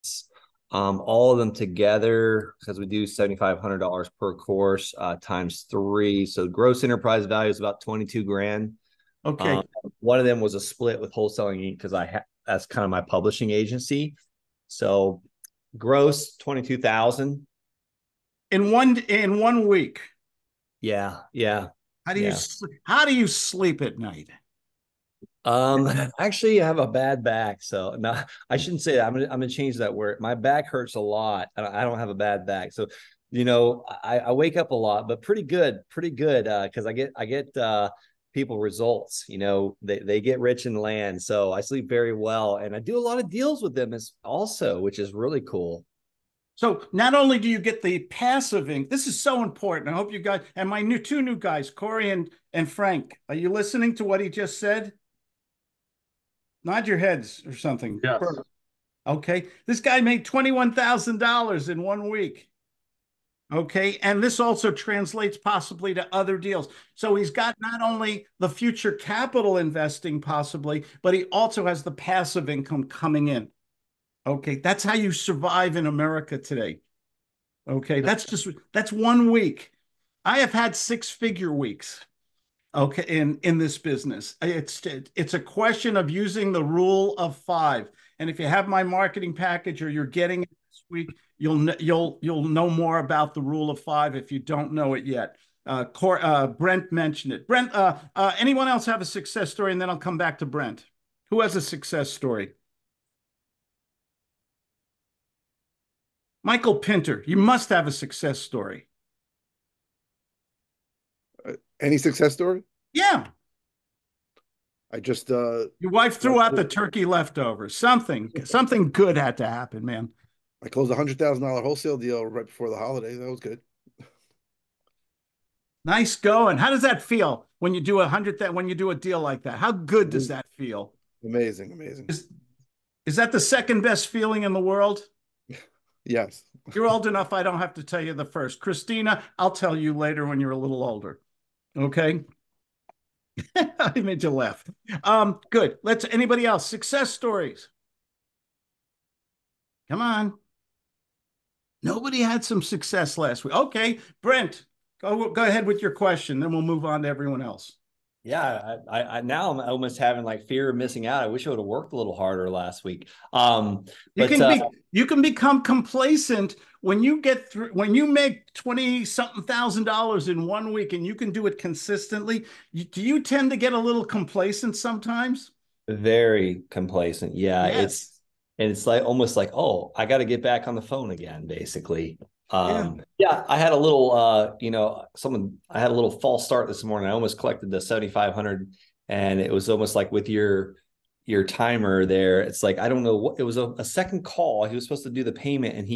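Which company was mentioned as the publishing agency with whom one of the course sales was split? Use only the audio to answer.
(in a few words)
Wholesaling Inc.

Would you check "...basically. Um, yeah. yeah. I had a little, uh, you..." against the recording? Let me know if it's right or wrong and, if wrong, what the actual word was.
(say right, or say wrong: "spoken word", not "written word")
right.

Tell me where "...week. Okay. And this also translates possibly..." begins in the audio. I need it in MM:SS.
01:02.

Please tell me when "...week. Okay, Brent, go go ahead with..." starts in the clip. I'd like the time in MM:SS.
02:33.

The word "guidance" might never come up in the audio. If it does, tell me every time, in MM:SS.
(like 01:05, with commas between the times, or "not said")
not said.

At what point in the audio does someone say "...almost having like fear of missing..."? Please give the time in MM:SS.
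02:39.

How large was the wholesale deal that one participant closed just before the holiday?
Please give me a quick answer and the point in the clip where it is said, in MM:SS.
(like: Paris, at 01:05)
$100,000, at 02:00.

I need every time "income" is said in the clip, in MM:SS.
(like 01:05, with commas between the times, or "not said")
00:48, 01:12.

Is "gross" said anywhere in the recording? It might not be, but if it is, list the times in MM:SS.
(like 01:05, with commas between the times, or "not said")
00:06, 00:15.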